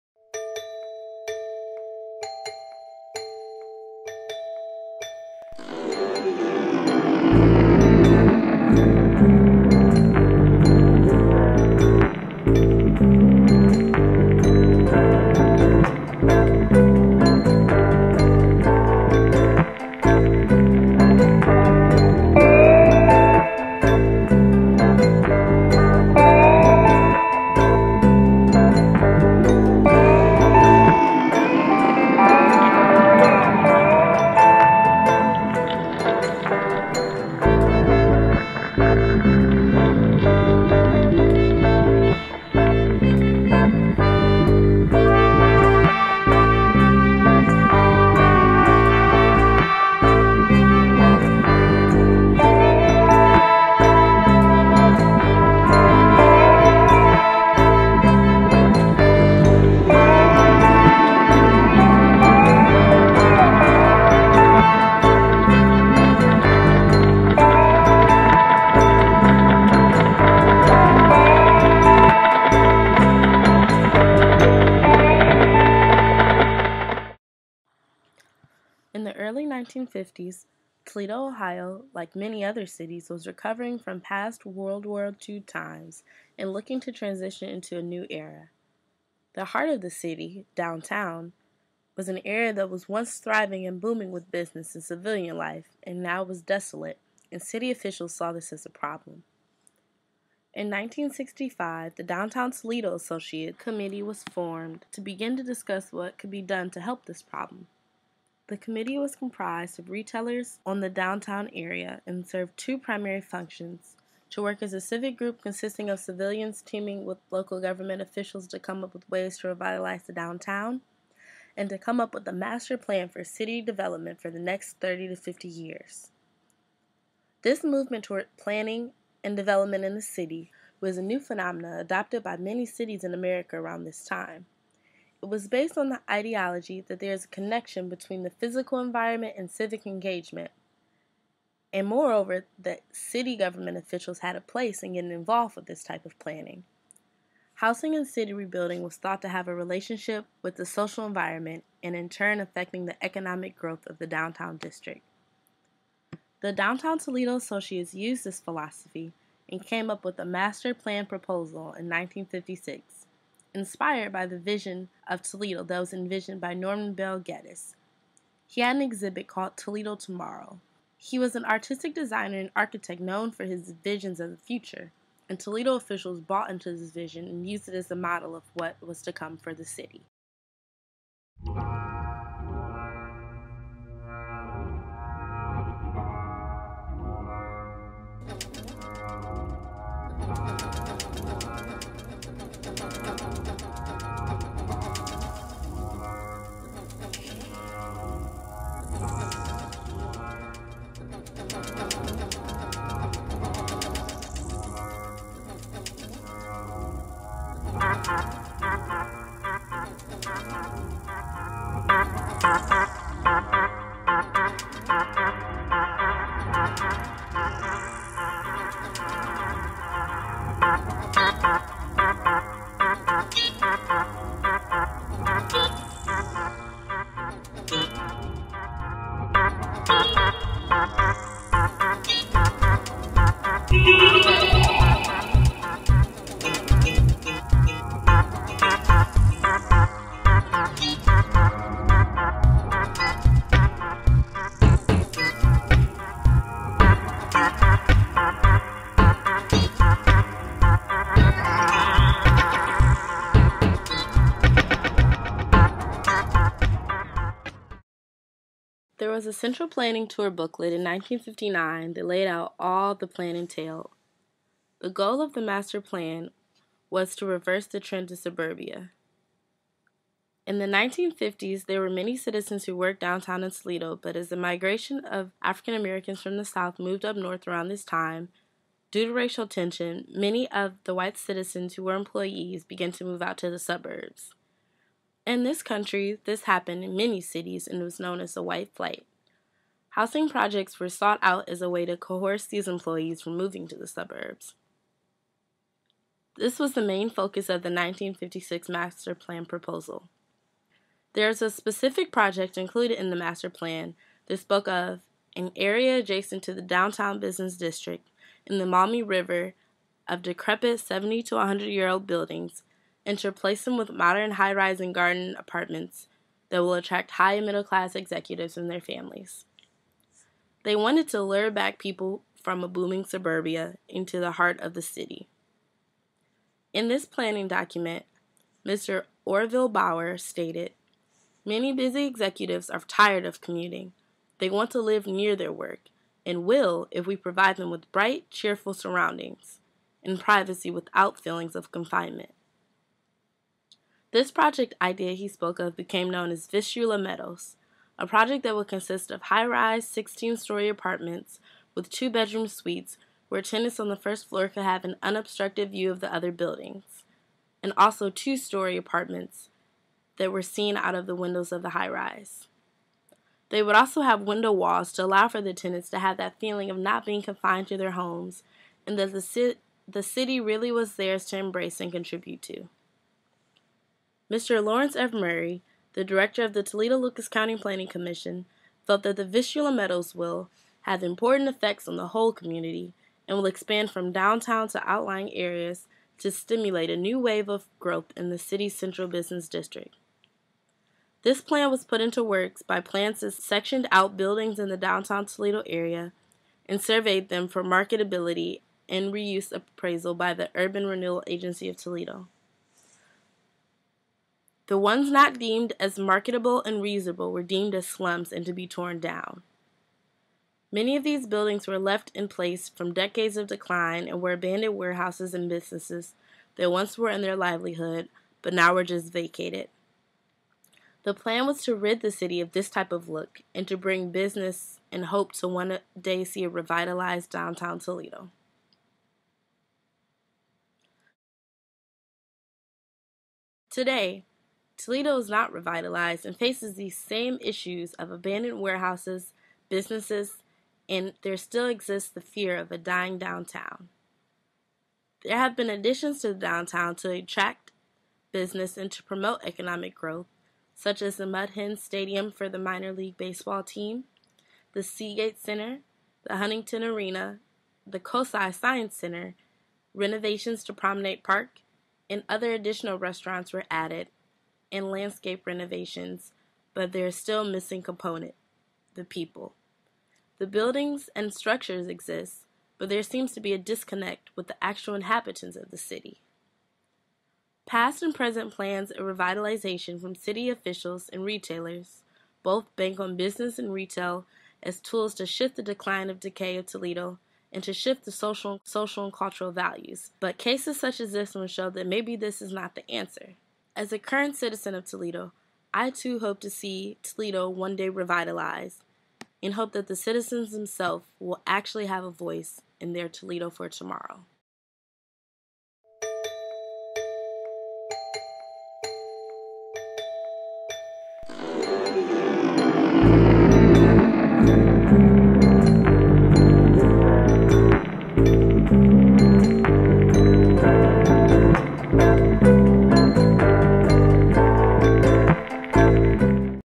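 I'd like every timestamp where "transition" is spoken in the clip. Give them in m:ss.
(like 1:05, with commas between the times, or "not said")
1:26.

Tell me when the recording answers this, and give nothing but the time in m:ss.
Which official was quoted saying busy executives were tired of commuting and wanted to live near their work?
5:29.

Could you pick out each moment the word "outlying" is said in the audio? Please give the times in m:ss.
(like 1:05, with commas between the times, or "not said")
6:24.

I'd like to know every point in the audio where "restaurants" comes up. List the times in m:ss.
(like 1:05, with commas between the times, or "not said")
7:42.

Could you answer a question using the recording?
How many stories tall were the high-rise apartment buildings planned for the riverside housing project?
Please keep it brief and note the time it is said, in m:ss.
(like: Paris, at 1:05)
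16, at 5:49.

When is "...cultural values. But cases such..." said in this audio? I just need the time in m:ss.
8:09.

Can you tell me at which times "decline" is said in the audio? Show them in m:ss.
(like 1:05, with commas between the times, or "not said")
6:53, 8:05.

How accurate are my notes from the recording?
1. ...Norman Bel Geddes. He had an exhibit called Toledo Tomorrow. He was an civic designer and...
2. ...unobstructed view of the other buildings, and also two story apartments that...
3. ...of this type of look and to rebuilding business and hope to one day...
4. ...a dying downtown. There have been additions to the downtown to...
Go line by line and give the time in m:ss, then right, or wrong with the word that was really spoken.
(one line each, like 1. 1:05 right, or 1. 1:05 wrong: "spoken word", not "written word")
1. 2:46 wrong: "artistic", not "civic"
2. 5:55 right
3. 7:02 wrong: "bring", not "rebuilding"
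4. 7:22 right.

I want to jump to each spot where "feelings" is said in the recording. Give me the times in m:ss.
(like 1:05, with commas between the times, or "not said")
5:41, 6:06.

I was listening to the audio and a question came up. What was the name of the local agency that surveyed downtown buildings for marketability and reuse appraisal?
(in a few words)
Urban Renewal Agency of Toledo.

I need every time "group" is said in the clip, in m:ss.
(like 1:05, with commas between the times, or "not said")
1:55.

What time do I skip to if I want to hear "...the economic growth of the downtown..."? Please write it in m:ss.
2:32.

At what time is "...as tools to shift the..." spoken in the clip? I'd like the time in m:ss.
8:04.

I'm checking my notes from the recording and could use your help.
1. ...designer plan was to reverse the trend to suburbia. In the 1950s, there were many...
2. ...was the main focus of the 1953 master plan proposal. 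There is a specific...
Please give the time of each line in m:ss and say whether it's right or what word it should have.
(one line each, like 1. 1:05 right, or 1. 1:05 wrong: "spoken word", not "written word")
1. 4:25 wrong: "master", not "designer"
2. 4:56 wrong: "1956", not "1953".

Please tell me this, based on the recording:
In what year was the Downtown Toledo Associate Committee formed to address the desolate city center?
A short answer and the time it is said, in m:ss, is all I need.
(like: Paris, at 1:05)
1965, at 1:40.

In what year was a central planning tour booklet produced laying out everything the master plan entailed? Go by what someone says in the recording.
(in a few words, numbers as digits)
1959.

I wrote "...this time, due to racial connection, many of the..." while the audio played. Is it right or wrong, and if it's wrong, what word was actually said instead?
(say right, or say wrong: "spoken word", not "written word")
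wrong: "tension", not "connection".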